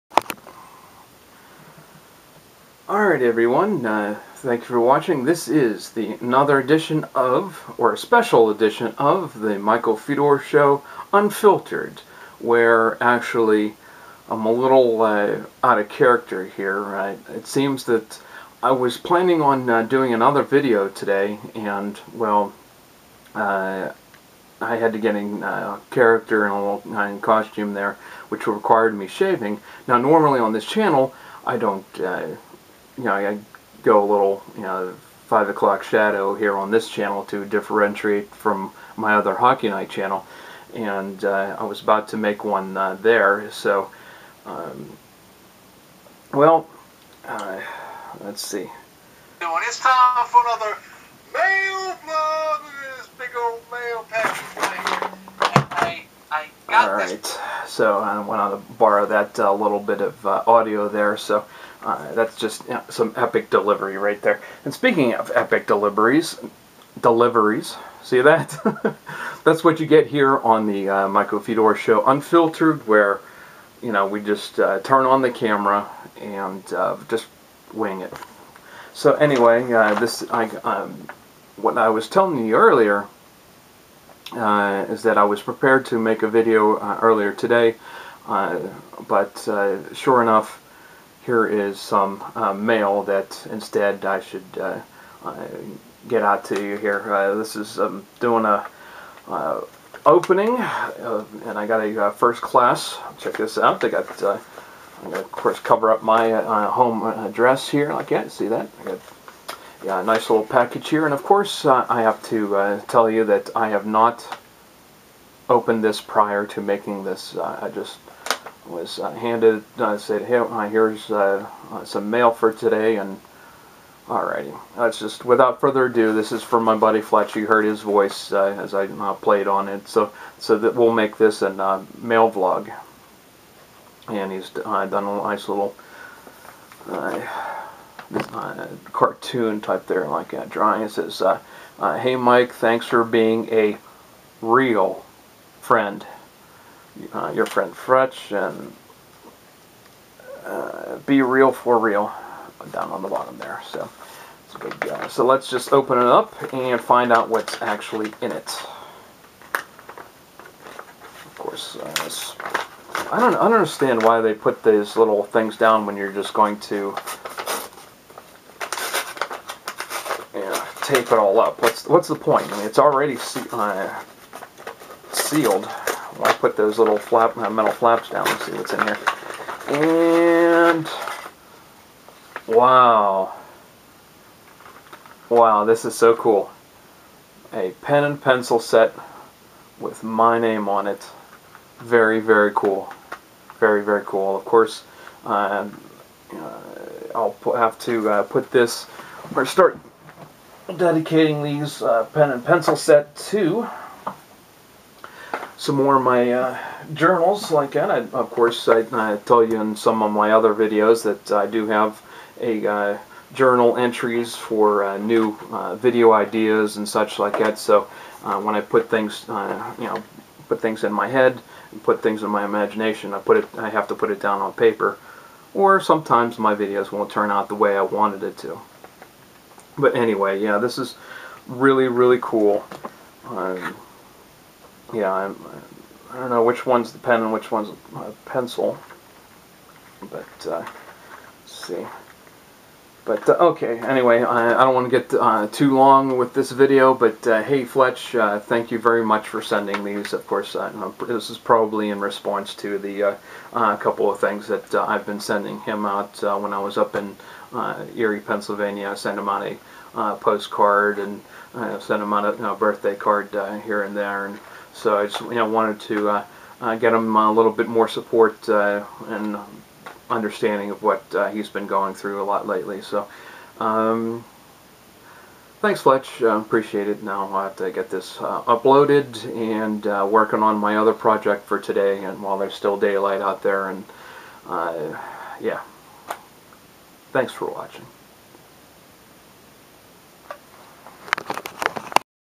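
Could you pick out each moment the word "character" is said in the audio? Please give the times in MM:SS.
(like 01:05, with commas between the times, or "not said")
00:15, 00:25.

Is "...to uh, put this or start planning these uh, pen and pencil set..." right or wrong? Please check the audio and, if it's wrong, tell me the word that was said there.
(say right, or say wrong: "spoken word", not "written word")
wrong: "dedicating", not "planning".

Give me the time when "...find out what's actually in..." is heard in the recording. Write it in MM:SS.
02:36.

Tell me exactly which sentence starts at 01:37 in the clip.
this is um, doing a opening, and I got a first class.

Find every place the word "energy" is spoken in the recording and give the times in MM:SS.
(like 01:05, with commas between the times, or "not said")
not said.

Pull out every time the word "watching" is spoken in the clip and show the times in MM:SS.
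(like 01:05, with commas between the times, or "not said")
00:04, 04:47.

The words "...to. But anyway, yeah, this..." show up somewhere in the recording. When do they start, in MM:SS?
03:48.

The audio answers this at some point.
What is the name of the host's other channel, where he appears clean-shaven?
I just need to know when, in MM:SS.
00:39.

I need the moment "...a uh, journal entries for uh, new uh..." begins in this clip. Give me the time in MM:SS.
03:32.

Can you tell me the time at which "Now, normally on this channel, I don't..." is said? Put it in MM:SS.
00:29.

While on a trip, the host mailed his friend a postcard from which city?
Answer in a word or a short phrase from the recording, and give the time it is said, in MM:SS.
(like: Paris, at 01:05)
Erie, Pennsylvania, at 04:17.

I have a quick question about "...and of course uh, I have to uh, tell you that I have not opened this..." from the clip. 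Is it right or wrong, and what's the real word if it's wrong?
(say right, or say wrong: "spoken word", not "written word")
right.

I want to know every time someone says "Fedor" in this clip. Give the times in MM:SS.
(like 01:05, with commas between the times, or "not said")
00:09, 01:11.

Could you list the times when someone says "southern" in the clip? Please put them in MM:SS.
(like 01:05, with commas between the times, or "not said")
not said.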